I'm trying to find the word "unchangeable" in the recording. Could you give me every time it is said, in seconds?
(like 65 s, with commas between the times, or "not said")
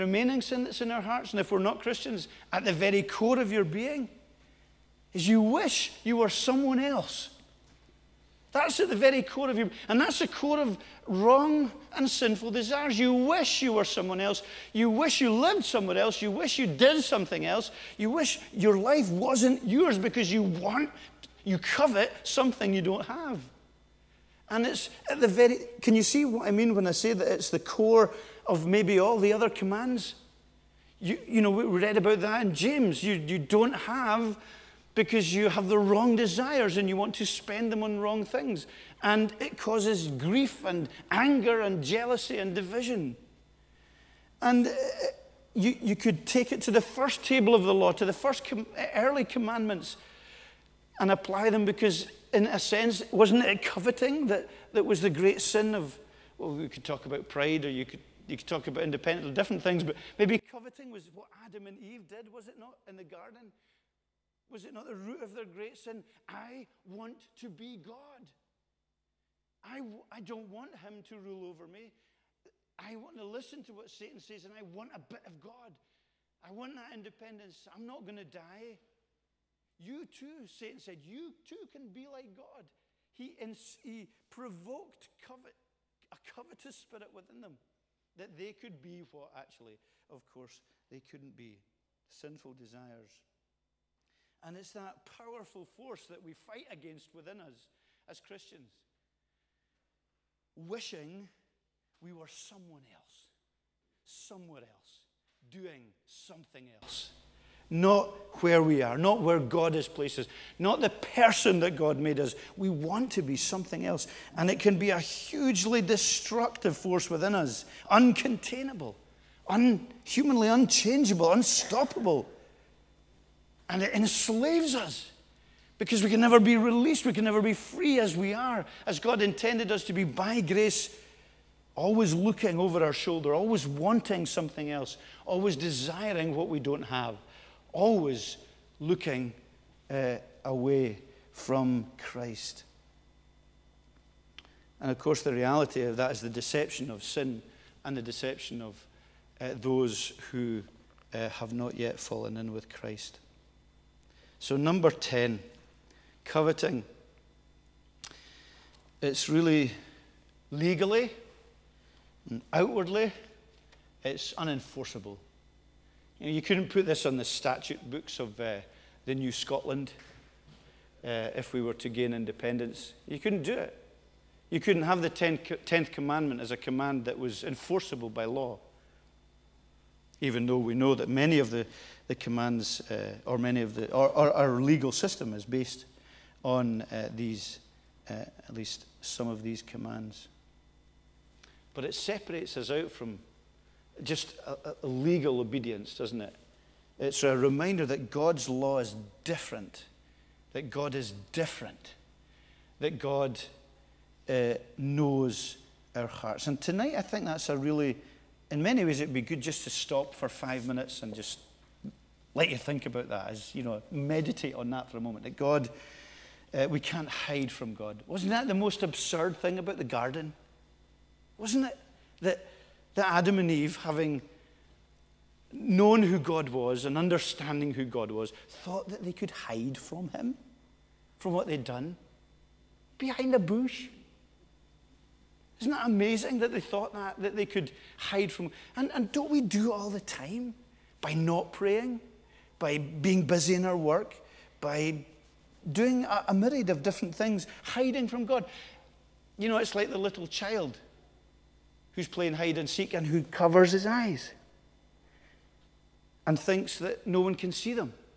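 120 s.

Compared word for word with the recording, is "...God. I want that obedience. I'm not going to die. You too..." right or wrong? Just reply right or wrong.
wrong.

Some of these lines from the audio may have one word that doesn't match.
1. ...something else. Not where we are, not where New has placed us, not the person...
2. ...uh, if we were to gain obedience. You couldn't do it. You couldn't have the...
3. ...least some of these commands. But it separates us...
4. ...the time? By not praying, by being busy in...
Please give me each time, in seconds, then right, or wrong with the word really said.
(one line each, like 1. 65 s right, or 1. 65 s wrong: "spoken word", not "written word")
1. 106 s wrong: "God", not "New"
2. 171 s wrong: "independence", not "obedience"
3. 188 s right
4. 239 s right.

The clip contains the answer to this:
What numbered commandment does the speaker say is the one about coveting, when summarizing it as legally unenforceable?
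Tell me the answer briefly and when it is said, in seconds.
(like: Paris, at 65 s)
10, at 154 s.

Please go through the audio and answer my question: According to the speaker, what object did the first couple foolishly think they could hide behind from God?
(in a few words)
A bush.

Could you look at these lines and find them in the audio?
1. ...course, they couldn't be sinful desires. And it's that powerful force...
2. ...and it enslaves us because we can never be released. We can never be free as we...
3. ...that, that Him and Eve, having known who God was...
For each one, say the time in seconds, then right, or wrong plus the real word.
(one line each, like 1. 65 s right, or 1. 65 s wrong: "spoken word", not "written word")
1. 90 s right
2. 123 s right
3. 222 s wrong: "Adam", not "Him".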